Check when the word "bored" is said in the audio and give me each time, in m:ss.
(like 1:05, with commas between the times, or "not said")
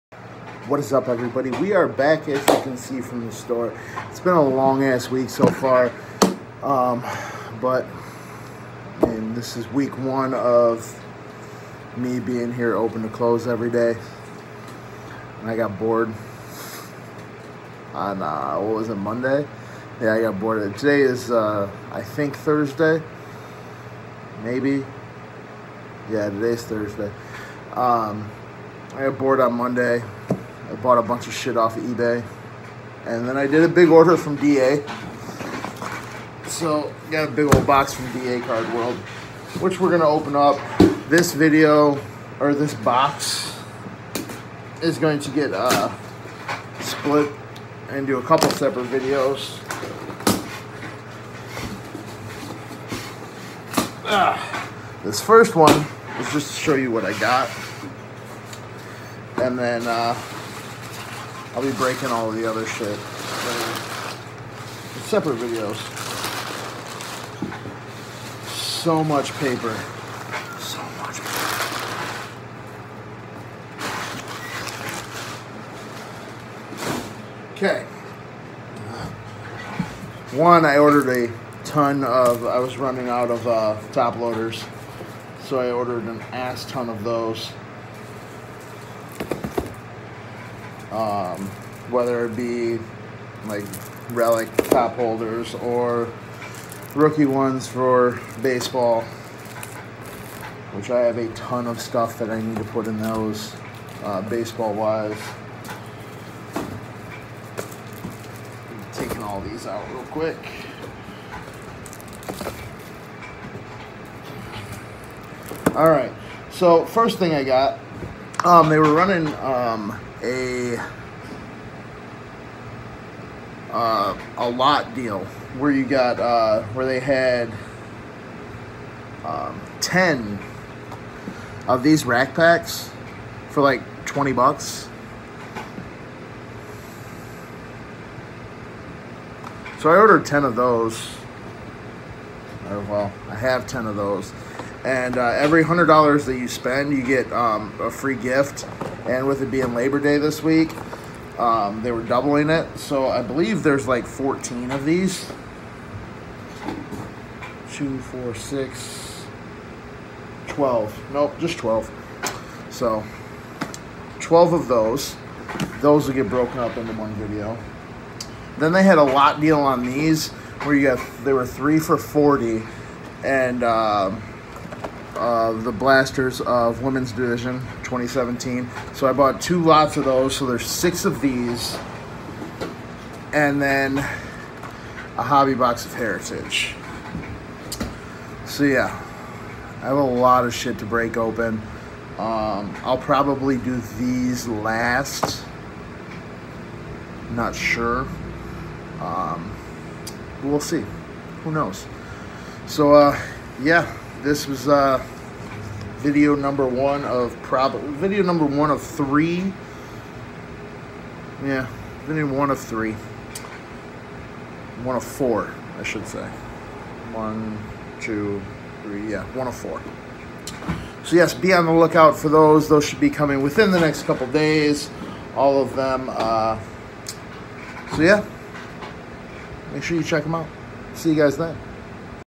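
0:15, 0:20, 0:29.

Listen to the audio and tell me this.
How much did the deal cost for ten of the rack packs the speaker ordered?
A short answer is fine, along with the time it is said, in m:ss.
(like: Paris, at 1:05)
$20, at 2:14.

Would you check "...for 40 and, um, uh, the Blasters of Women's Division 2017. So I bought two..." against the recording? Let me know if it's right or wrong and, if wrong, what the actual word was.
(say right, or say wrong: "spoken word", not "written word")
right.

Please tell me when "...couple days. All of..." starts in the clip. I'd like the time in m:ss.
3:44.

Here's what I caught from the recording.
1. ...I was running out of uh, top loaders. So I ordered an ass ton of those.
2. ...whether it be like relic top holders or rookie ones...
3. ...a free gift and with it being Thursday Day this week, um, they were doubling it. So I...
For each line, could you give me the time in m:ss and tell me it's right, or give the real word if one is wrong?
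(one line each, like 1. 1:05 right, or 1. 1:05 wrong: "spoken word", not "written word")
1. 1:22 right
2. 1:31 right
3. 2:27 wrong: "Labor", not "Thursday".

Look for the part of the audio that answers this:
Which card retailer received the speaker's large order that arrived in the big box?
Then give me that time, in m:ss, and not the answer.
0:38.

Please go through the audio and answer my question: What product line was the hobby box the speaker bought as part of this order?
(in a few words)
Heritage.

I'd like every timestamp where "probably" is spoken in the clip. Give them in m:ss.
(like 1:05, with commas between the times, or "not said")
3:12, 3:27.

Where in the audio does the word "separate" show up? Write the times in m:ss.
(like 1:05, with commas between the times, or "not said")
0:48, 1:05.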